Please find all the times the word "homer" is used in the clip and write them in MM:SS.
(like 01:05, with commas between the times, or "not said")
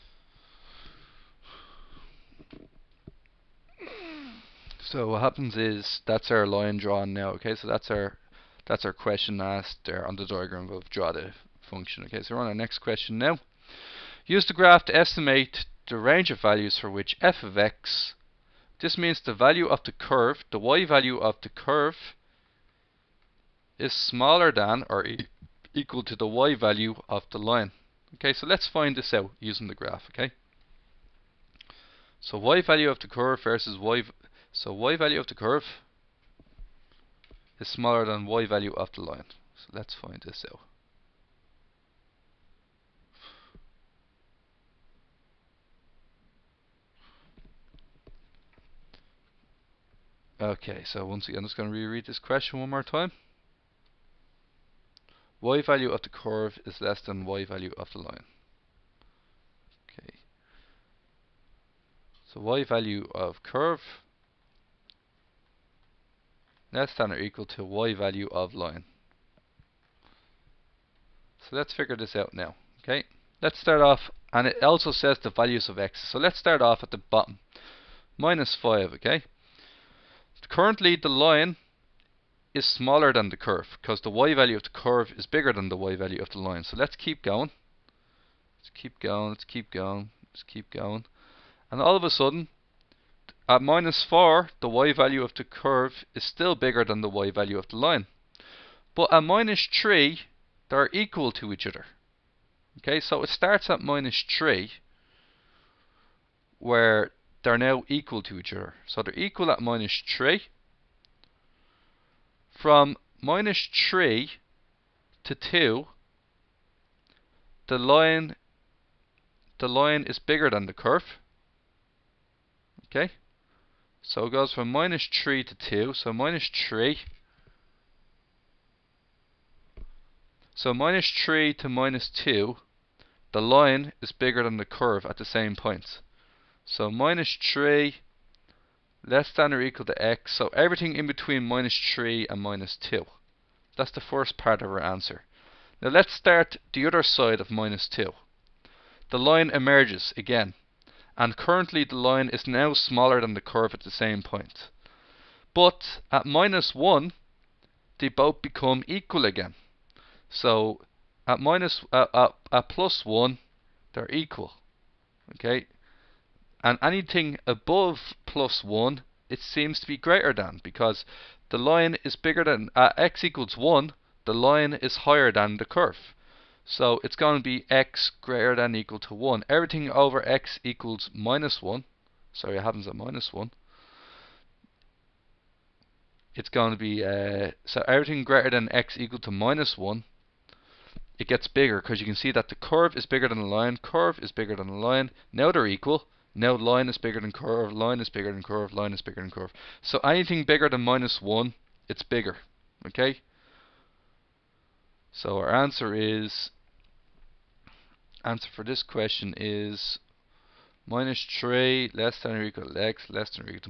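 not said.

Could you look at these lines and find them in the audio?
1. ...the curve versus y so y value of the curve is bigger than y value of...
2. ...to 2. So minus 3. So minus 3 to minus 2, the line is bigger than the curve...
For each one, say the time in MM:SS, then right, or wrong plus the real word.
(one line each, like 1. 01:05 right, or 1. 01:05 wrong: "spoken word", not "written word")
1. 00:32 wrong: "smaller", not "bigger"
2. 02:05 right.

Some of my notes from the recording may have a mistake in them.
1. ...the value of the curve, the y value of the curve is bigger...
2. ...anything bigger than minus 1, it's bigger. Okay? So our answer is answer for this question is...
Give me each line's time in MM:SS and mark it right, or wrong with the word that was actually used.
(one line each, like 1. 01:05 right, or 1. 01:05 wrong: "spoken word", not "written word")
1. 00:19 wrong: "smaller", not "bigger"
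2. 03:19 right.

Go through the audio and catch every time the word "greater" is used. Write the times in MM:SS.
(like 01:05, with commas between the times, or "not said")
02:49, 02:58, 03:08.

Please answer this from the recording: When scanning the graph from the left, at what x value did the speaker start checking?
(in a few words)
-5.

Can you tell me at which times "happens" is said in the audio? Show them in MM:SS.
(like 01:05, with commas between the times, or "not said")
00:05, 03:02.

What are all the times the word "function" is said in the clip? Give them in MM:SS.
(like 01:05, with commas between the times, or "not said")
00:11.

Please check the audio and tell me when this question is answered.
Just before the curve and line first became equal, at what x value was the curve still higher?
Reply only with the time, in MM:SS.
01:33.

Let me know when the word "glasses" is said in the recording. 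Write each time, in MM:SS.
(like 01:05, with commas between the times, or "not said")
not said.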